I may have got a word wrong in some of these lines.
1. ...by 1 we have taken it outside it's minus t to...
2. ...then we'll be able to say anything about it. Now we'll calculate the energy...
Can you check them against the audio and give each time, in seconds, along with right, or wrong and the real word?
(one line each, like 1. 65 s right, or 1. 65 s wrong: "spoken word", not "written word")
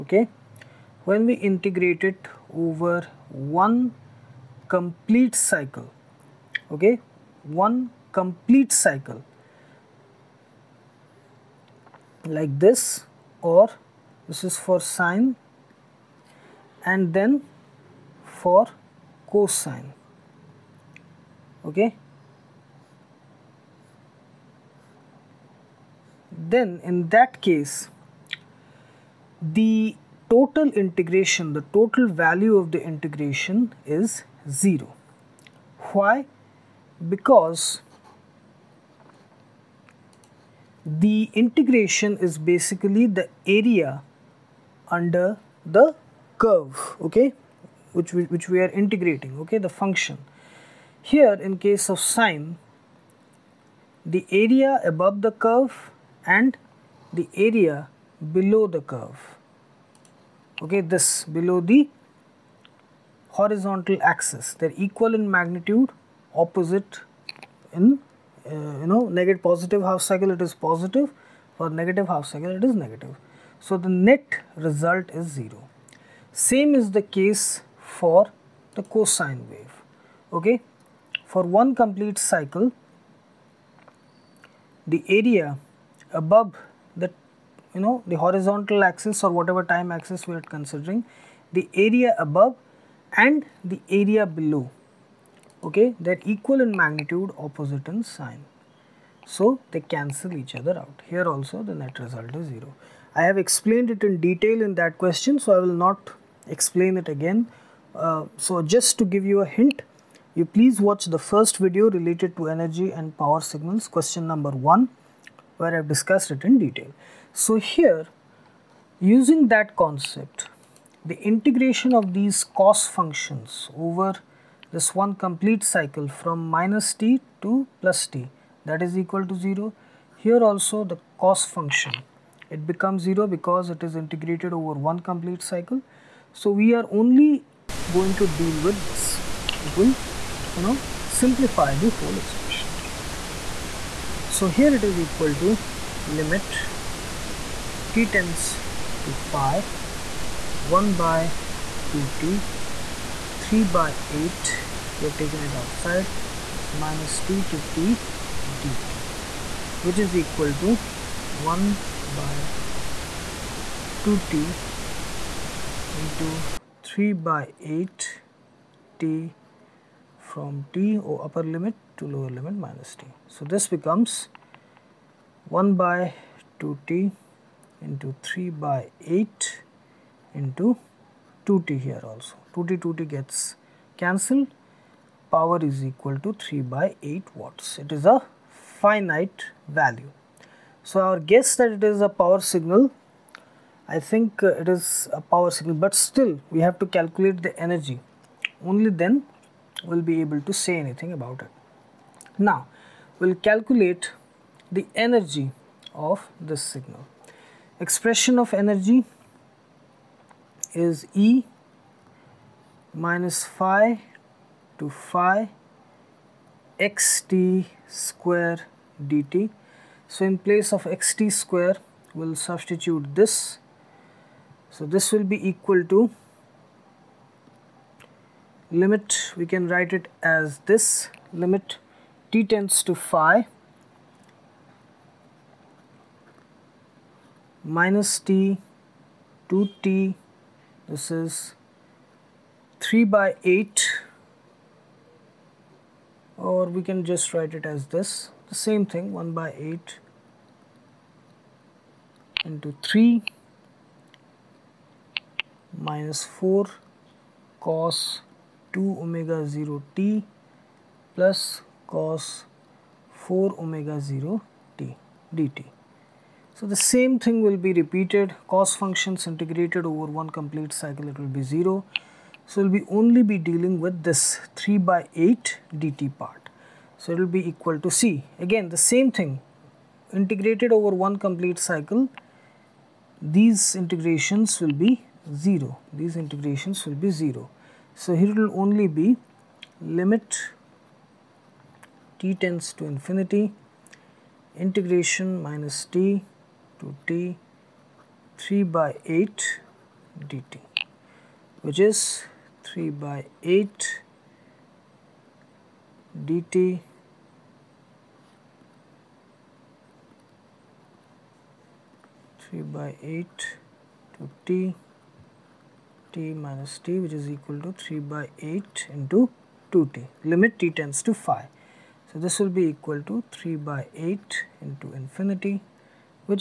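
1. 153 s wrong: "8", not "1"
2. 198 s right.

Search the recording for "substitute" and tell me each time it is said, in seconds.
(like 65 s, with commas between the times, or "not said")
222 s.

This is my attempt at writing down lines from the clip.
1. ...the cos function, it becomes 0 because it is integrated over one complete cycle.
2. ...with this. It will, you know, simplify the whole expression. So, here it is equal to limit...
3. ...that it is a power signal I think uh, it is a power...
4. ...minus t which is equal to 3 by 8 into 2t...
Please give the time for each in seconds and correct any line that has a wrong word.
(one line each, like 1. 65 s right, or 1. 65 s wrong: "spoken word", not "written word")
1. 130 s right
2. 138 s right
3. 191 s right
4. 316 s right.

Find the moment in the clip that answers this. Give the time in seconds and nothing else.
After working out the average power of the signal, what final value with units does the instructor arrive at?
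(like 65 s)
186 s.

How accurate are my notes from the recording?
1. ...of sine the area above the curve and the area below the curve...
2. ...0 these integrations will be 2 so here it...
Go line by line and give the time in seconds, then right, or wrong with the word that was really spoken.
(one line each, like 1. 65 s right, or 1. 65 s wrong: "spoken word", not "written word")
1. 51 s right
2. 285 s wrong: "0", not "2".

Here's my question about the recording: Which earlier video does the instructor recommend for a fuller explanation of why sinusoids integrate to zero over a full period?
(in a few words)
energy and power signals, question 1.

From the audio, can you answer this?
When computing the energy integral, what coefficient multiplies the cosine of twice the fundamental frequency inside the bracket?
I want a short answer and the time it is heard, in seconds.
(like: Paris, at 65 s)
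-4, at 255 s.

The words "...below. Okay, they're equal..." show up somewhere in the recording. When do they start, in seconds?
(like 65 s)
94 s.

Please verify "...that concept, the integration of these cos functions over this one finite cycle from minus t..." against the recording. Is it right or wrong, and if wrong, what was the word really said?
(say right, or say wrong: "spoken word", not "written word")
wrong: "complete", not "finite".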